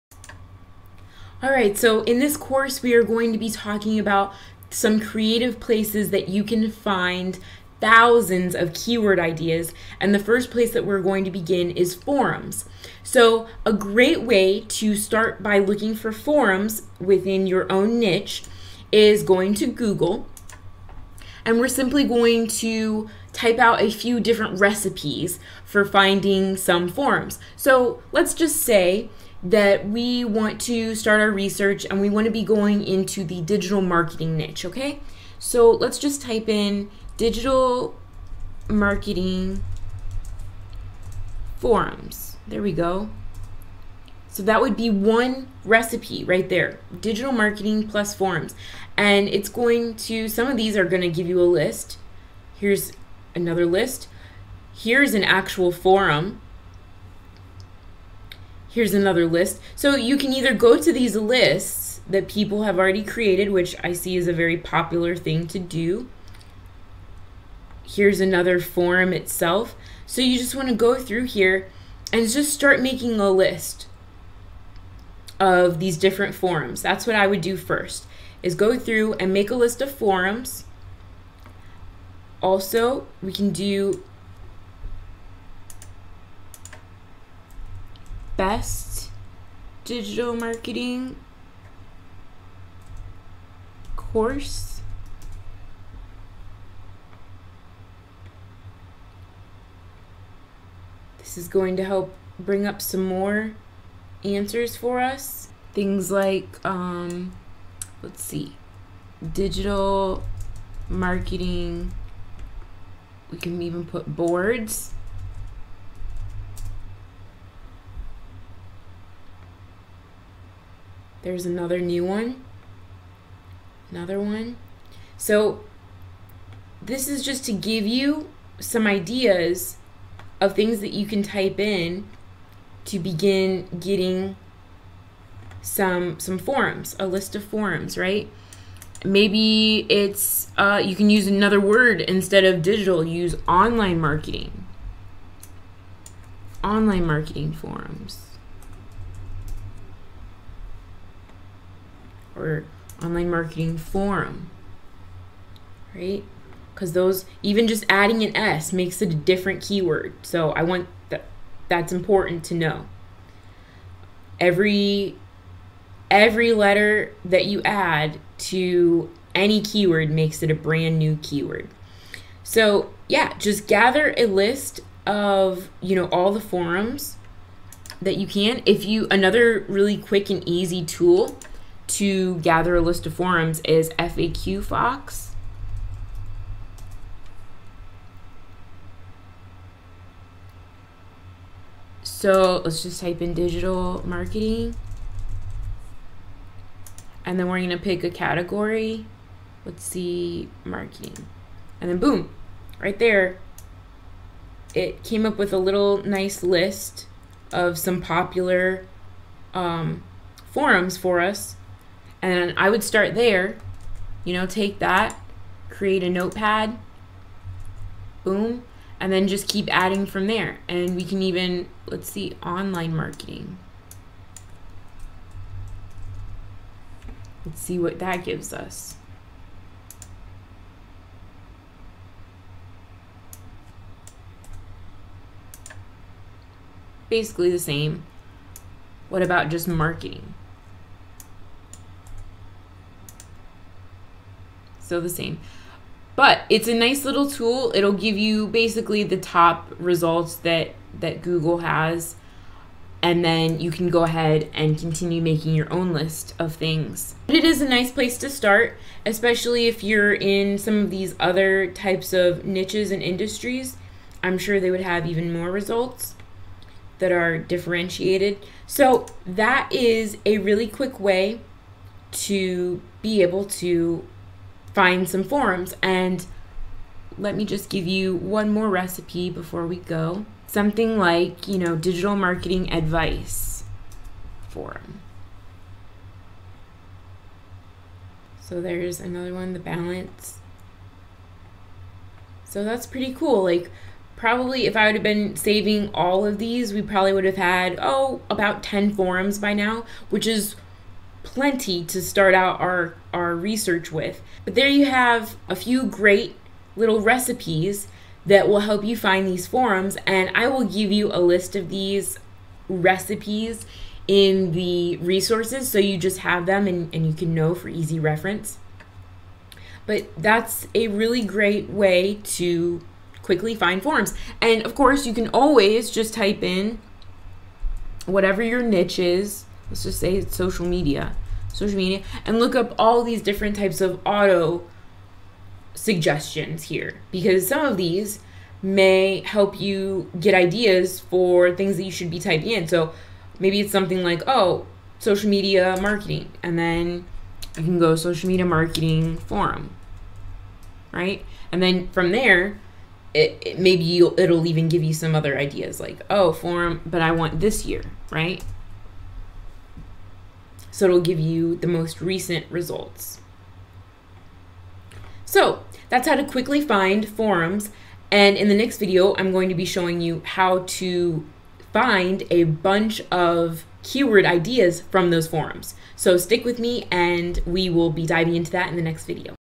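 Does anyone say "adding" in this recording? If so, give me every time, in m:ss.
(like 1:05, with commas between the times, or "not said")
2:37, 3:39.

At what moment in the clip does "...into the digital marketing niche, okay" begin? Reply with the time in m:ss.
0:32.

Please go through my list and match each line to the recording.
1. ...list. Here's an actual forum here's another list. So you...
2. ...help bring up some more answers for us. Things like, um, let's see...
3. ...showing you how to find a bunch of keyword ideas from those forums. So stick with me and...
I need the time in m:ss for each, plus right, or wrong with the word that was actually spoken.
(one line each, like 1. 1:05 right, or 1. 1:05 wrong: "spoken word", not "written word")
1. 0:53 right
2. 1:41 right
3. 6:09 right.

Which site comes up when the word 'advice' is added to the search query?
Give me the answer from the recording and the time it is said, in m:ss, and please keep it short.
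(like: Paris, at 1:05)
The Balance, at 4:49.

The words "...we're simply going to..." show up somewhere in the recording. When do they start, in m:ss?
0:21.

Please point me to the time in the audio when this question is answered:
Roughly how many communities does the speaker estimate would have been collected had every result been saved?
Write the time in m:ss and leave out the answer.
4:58.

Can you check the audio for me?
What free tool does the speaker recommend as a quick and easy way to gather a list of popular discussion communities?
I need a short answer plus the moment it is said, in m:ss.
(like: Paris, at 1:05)
FAQ Fox, at 3:03.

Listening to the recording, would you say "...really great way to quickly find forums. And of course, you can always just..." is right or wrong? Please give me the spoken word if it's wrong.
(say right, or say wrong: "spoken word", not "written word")
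right.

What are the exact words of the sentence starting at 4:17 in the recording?
But it is a nice place to start, especially if you're in some of these other types of niches and industries.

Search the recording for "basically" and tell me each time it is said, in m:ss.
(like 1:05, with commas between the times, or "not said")
3:57, 4:08.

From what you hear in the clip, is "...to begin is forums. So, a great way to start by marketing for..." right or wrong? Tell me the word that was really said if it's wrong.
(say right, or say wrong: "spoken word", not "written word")
wrong: "looking", not "marketing".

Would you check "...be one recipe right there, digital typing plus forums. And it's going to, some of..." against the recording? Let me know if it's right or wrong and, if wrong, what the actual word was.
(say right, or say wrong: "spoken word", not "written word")
wrong: "marketing", not "typing".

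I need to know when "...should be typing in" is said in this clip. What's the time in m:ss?
5:41.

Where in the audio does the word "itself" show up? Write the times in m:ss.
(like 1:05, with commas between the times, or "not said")
1:09.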